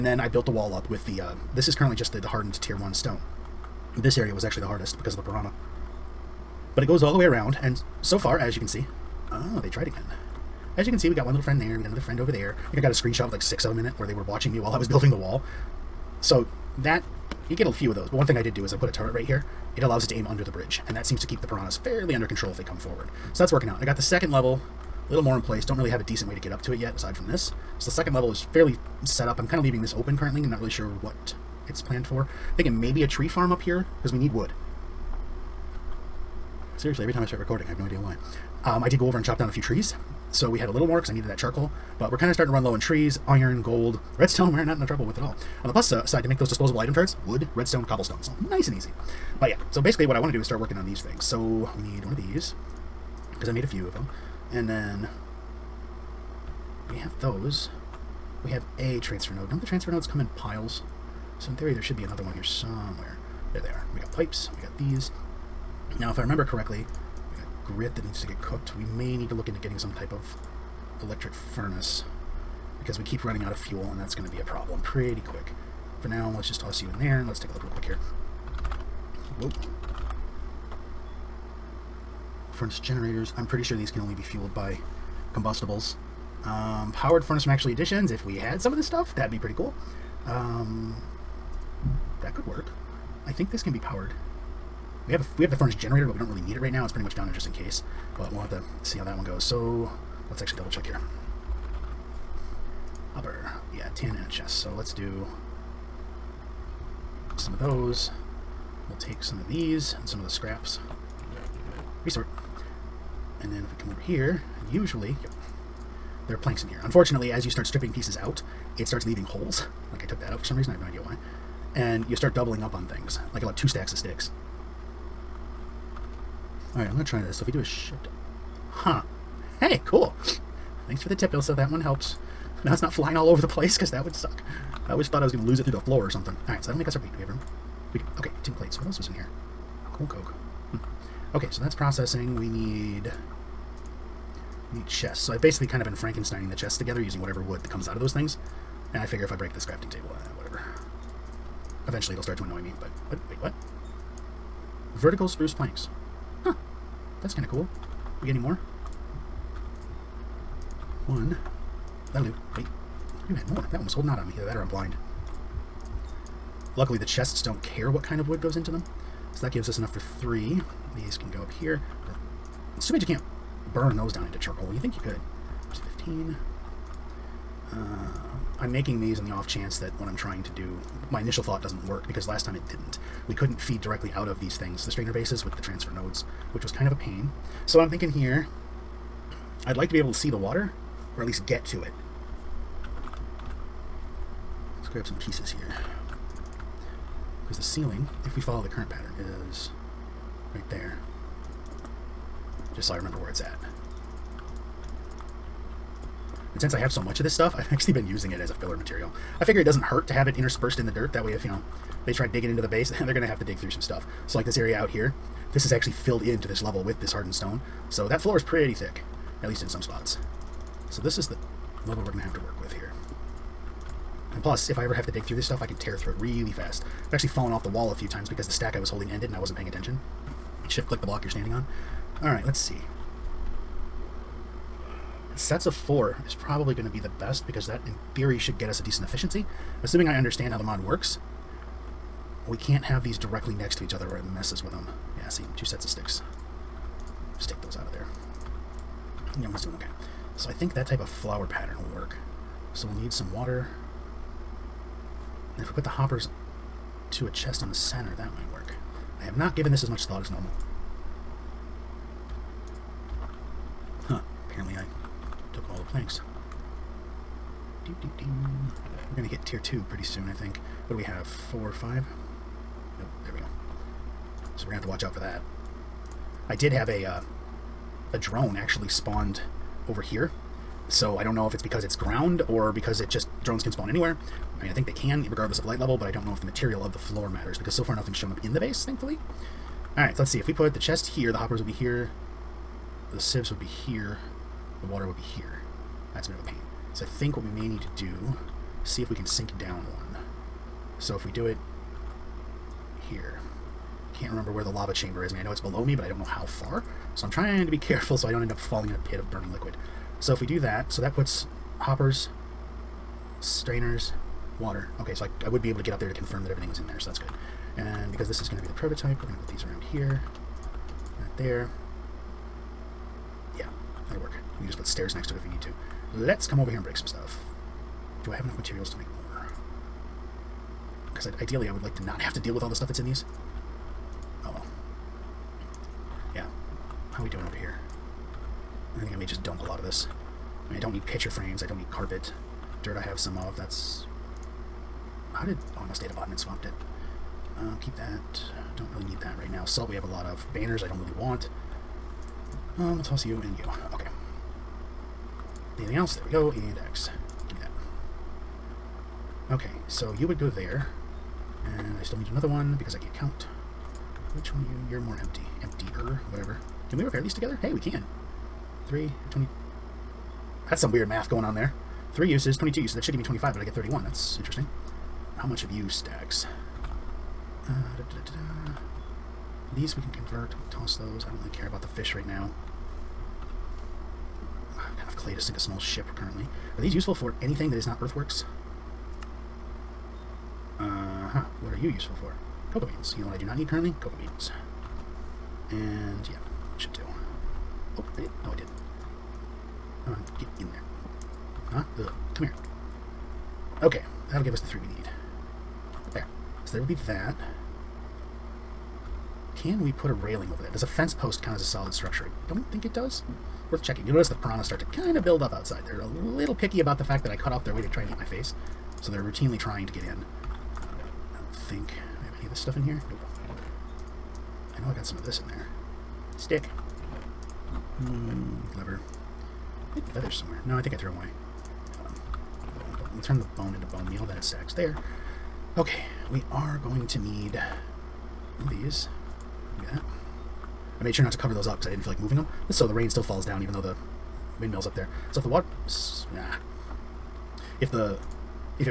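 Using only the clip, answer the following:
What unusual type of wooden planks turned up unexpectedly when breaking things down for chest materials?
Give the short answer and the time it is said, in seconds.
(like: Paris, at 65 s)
Vertical spruce planks, at 154 s.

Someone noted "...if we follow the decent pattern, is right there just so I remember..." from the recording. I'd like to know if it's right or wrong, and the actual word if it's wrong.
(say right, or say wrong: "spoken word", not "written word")
wrong: "current", not "decent".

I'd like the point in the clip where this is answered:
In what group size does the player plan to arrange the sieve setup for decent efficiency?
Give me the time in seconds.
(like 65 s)
235 s.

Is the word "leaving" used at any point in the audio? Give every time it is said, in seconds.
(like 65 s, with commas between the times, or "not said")
29 s, 119 s.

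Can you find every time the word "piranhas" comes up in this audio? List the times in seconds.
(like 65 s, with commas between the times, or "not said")
5 s, 21 s, 414 s.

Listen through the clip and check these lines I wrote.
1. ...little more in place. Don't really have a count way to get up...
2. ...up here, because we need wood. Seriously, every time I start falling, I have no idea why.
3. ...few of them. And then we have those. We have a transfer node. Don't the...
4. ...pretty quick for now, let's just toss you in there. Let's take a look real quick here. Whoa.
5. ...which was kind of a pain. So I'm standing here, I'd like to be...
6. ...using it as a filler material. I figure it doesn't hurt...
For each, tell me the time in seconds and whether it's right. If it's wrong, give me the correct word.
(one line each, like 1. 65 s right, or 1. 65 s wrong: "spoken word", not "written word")
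1. 25 s wrong: "decent", not "count"
2. 33 s wrong: "recording", not "falling"
3. 53 s right
4. 74 s right
5. 186 s wrong: "thinking", not "standing"
6. 208 s right.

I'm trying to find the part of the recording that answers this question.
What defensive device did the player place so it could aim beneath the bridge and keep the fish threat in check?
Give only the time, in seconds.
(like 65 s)
18 s.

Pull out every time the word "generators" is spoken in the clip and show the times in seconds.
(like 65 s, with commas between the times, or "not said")
82 s, 95 s.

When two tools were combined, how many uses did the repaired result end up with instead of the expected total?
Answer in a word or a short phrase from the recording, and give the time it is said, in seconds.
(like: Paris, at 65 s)
31, at 373 s.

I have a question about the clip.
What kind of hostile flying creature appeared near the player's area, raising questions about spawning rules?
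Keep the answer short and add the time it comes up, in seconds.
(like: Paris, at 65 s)
drone, at 278 s.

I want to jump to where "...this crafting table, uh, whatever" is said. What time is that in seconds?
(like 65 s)
149 s.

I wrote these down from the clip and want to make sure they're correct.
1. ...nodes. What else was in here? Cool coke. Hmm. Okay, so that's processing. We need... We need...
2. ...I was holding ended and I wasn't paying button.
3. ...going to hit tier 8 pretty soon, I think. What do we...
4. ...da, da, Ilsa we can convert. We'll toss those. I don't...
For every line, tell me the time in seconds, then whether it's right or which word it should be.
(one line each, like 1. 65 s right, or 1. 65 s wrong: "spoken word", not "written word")
1. 138 s wrong: "plates", not "nodes"
2. 228 s wrong: "attention", not "button"
3. 269 s wrong: "2", not "8"
4. 378 s wrong: "These", not "Ilsa".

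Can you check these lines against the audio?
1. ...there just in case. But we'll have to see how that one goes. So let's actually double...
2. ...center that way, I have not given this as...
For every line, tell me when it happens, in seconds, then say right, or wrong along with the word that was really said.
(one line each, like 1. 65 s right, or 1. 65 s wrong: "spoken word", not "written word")
1. 97 s right
2. 257 s right.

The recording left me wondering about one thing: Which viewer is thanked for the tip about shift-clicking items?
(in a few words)
Ilsa.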